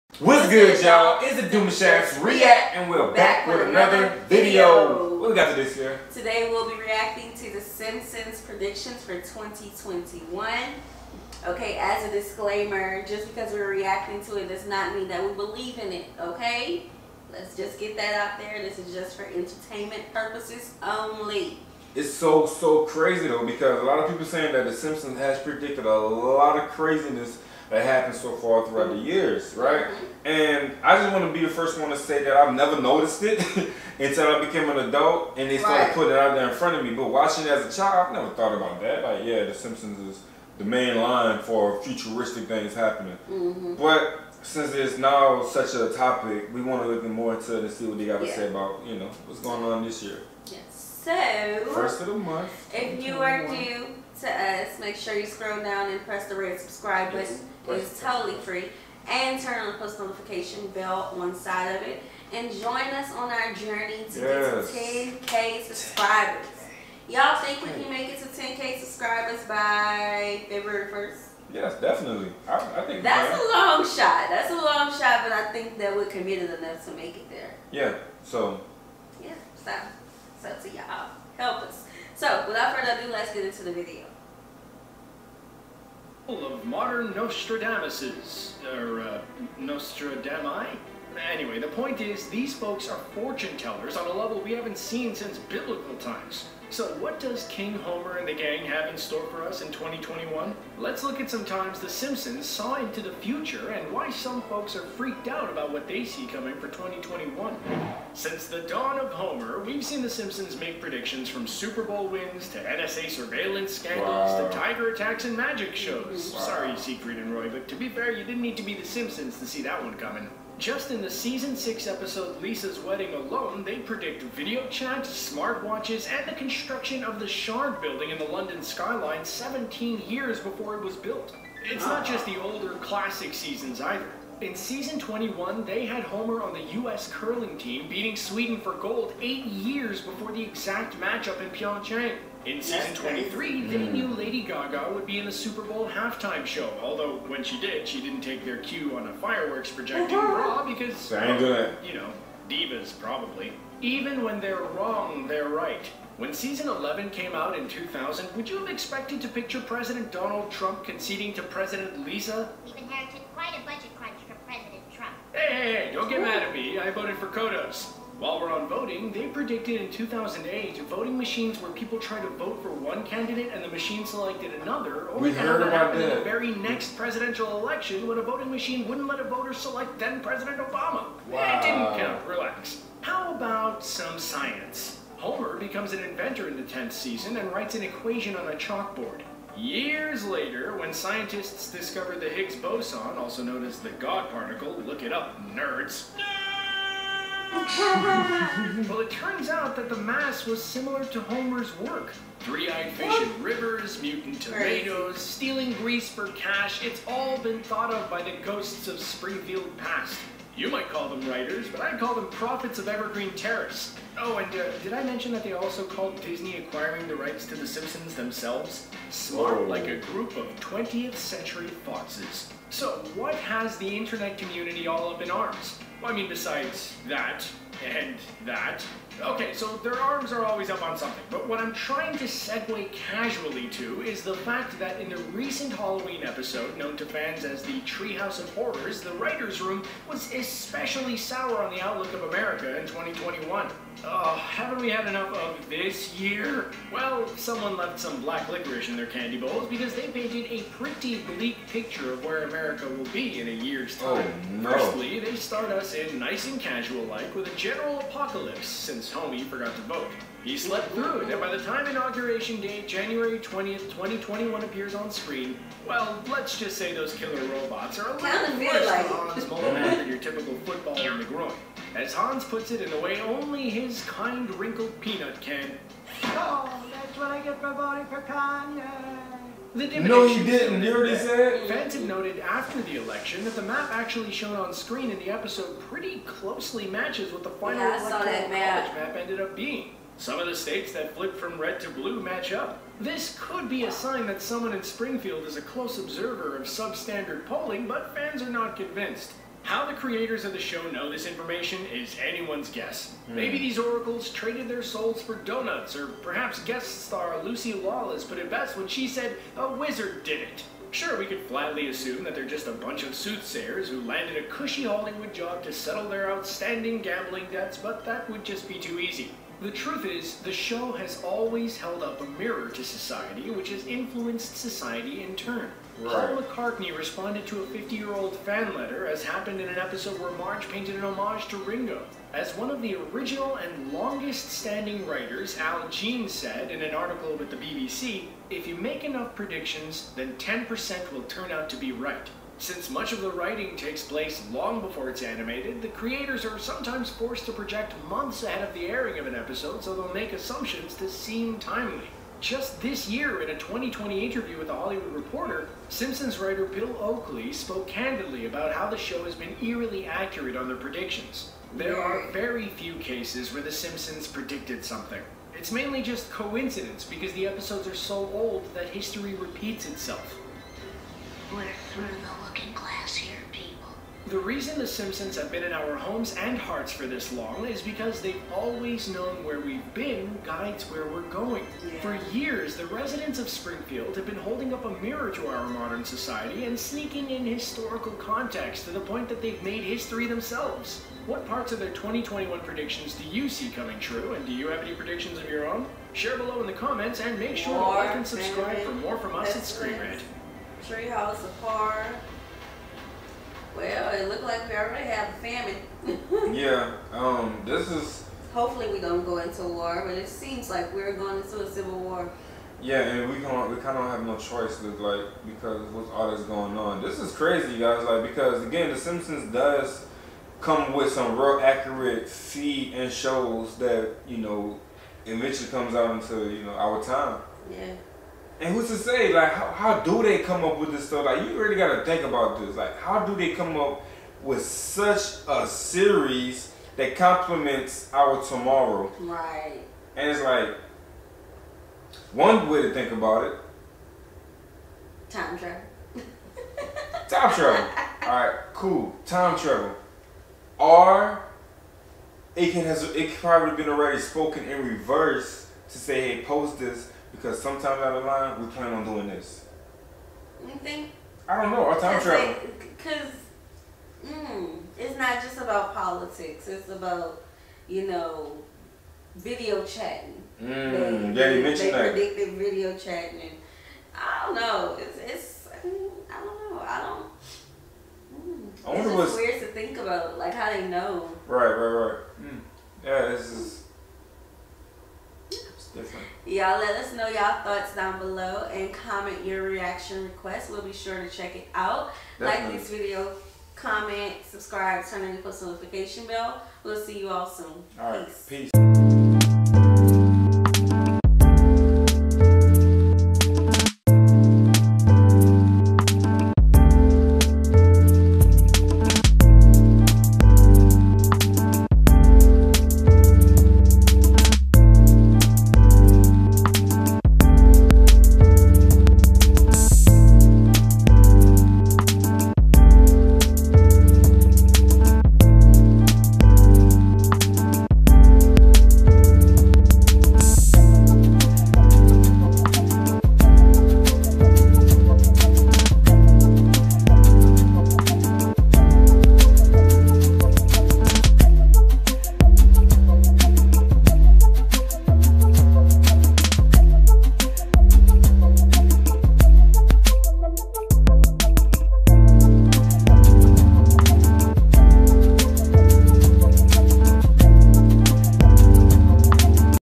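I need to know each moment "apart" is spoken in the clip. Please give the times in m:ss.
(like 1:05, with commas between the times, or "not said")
6:41.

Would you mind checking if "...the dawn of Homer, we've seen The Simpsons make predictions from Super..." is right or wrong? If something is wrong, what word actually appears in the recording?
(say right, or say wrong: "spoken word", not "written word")
right.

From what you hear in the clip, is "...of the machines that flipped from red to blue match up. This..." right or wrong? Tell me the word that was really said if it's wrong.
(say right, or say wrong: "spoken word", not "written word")
wrong: "states", not "machines".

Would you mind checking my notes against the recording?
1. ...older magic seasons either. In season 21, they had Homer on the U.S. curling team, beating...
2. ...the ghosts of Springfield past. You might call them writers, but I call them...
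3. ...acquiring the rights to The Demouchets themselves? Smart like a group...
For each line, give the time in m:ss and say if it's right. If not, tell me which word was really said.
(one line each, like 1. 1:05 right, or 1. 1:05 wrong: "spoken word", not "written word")
1. 2:12 wrong: "classic", not "magic"
2. 3:28 right
3. 3:36 wrong: "Simpsons", not "Demouchets".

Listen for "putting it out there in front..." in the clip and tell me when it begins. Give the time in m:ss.
0:35.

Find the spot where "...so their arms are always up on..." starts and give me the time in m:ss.
3:49.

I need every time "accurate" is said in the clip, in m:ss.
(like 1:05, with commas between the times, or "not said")
6:00, 7:01.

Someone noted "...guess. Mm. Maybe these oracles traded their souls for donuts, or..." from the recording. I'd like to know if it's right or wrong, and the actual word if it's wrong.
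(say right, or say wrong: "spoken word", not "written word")
right.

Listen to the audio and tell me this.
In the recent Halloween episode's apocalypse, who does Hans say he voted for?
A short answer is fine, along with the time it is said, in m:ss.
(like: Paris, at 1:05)
Kanye, at 4:38.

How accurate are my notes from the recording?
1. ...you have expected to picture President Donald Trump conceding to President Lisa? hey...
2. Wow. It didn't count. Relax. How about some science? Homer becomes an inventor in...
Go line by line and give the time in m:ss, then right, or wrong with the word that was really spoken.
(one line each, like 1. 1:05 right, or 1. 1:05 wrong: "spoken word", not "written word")
1. 2:38 right
2. 3:01 right.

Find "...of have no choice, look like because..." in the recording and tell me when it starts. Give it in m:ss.
6:53.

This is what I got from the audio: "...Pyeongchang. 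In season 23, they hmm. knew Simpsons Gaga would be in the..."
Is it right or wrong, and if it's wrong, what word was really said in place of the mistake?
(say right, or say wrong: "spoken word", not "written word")
wrong: "Lady", not "Simpsons".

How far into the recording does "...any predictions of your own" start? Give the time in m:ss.
6:34.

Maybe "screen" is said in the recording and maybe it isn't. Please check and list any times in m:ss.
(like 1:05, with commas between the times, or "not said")
4:25, 4:44, 6:39.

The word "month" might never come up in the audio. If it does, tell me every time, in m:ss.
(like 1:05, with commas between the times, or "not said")
0:52, 5:48.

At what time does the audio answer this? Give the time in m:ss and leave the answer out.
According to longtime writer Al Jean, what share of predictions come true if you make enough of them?
5:40.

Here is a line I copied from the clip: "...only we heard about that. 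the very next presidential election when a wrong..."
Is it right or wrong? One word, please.
wrong.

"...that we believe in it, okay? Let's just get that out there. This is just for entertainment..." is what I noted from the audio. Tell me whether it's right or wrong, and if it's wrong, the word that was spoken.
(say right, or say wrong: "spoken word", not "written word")
right.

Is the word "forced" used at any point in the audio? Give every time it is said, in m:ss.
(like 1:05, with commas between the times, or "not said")
5:47.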